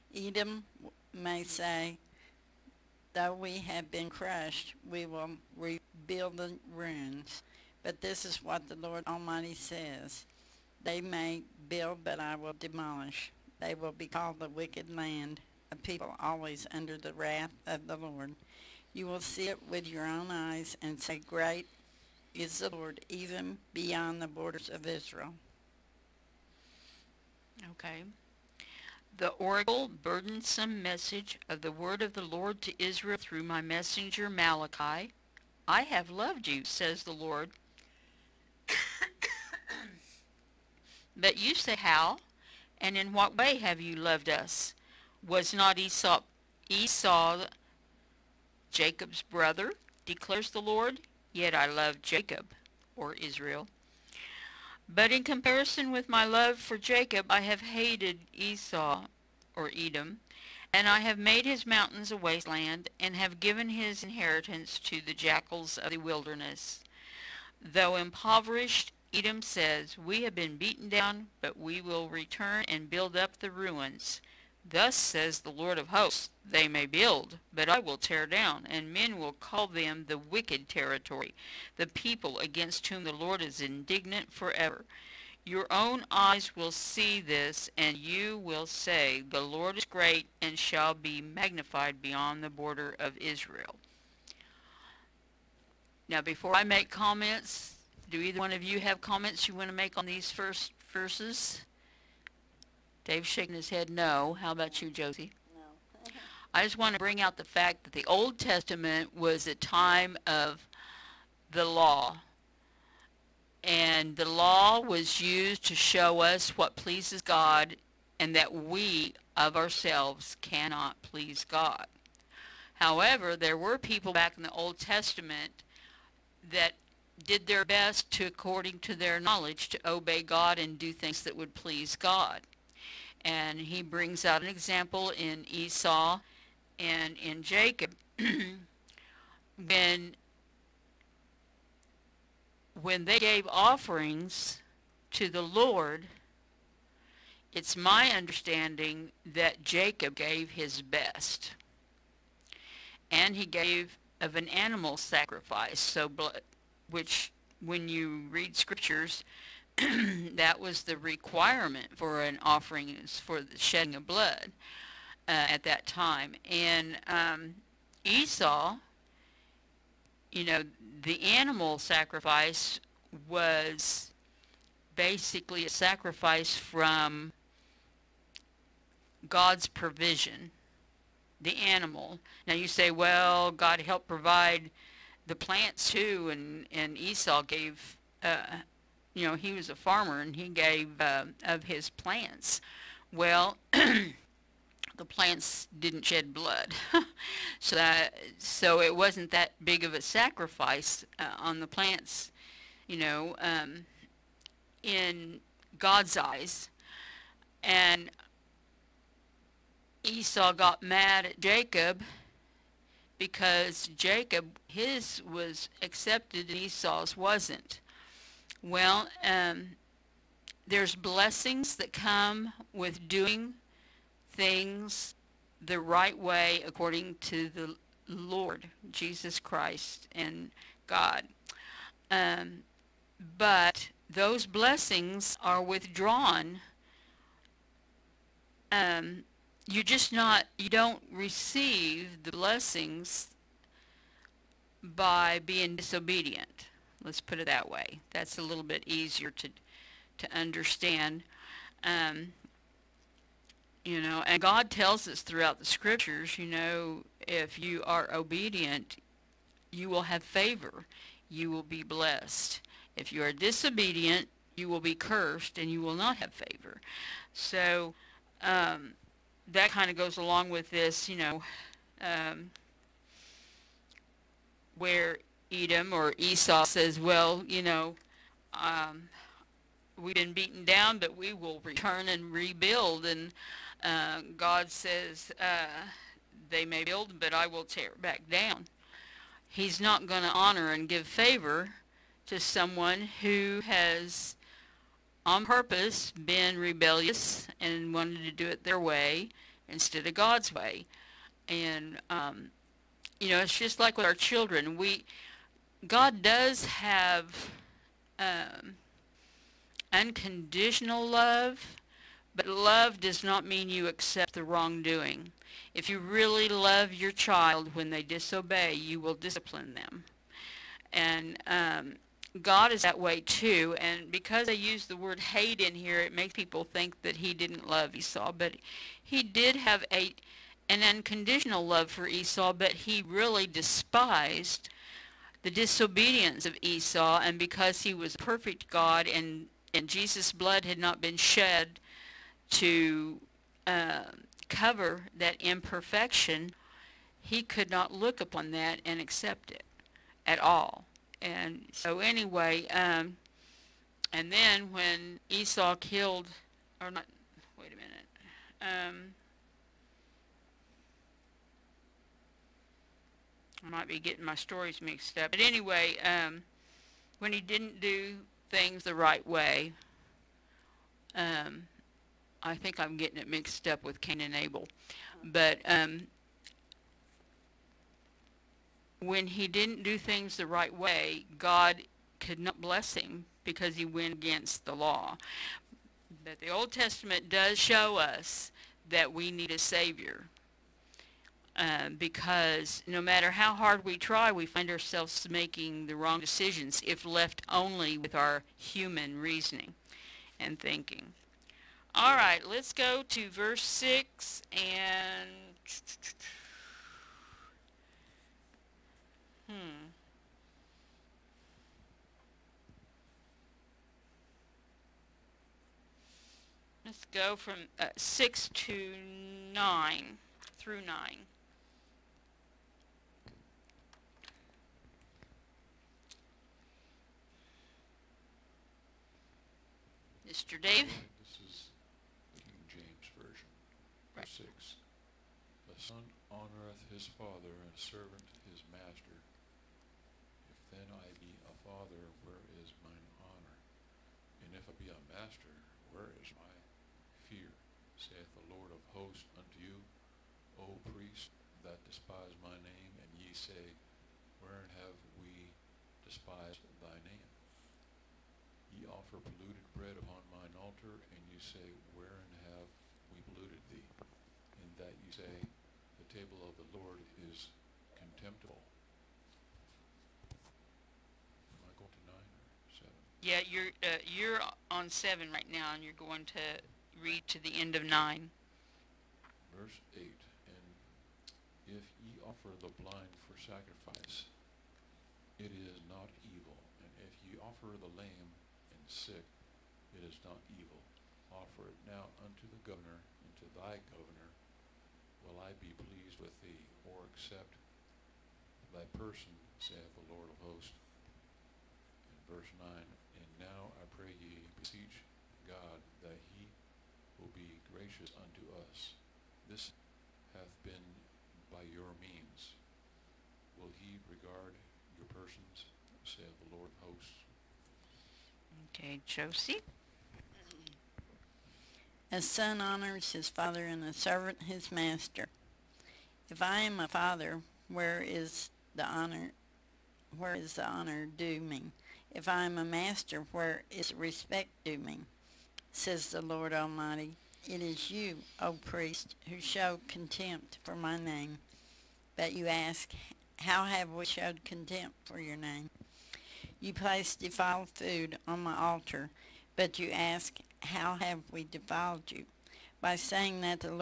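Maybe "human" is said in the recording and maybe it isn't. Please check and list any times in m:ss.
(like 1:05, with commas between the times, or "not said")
6:38.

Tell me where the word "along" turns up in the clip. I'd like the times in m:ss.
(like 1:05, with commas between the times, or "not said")
4:30.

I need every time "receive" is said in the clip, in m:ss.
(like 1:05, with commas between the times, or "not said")
4:01.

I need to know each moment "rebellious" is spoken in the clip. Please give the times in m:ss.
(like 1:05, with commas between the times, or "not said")
4:56.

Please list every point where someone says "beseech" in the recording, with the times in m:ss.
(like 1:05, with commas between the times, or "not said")
8:24.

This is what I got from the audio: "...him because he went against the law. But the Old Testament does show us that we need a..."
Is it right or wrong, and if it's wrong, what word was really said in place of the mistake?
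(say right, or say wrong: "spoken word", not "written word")
right.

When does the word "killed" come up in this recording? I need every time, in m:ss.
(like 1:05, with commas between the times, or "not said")
5:55.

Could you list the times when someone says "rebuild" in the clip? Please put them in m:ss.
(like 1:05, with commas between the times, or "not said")
0:05, 4:42.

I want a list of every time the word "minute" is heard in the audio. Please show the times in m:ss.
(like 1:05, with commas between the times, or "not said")
5:57.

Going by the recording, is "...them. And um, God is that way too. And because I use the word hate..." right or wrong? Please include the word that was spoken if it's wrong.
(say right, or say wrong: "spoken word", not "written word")
right.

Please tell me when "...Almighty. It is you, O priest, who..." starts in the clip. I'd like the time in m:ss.
8:56.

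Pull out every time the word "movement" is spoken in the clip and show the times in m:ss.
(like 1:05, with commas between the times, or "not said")
not said.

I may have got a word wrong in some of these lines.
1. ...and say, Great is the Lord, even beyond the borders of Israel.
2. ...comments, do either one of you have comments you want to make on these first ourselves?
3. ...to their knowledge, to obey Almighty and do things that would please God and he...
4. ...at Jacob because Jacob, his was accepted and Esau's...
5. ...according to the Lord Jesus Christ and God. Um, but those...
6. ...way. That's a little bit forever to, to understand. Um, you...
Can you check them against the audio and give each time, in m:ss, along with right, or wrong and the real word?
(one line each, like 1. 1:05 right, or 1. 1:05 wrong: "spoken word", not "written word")
1. 0:20 right
2. 1:36 wrong: "verses", not "ourselves"
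3. 2:08 wrong: "God", not "Almighty"
4. 3:31 right
5. 3:46 right
6. 4:07 wrong: "easier", not "forever".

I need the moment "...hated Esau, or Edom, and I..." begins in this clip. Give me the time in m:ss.
0:57.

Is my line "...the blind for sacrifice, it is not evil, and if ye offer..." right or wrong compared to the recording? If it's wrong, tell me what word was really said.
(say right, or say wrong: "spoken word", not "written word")
right.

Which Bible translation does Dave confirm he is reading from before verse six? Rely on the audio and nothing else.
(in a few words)
King James Version.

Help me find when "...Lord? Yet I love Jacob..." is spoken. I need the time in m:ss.
0:50.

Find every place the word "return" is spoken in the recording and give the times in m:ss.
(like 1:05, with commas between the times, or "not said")
1:12, 4:41.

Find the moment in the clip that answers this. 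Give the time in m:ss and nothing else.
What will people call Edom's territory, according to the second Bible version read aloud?
1:20.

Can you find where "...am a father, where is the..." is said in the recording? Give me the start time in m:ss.
8:46.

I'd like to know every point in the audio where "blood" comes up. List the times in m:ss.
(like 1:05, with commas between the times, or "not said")
2:44, 3:16, 5:40.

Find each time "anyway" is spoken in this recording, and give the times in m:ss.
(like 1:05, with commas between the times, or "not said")
5:51, 6:05.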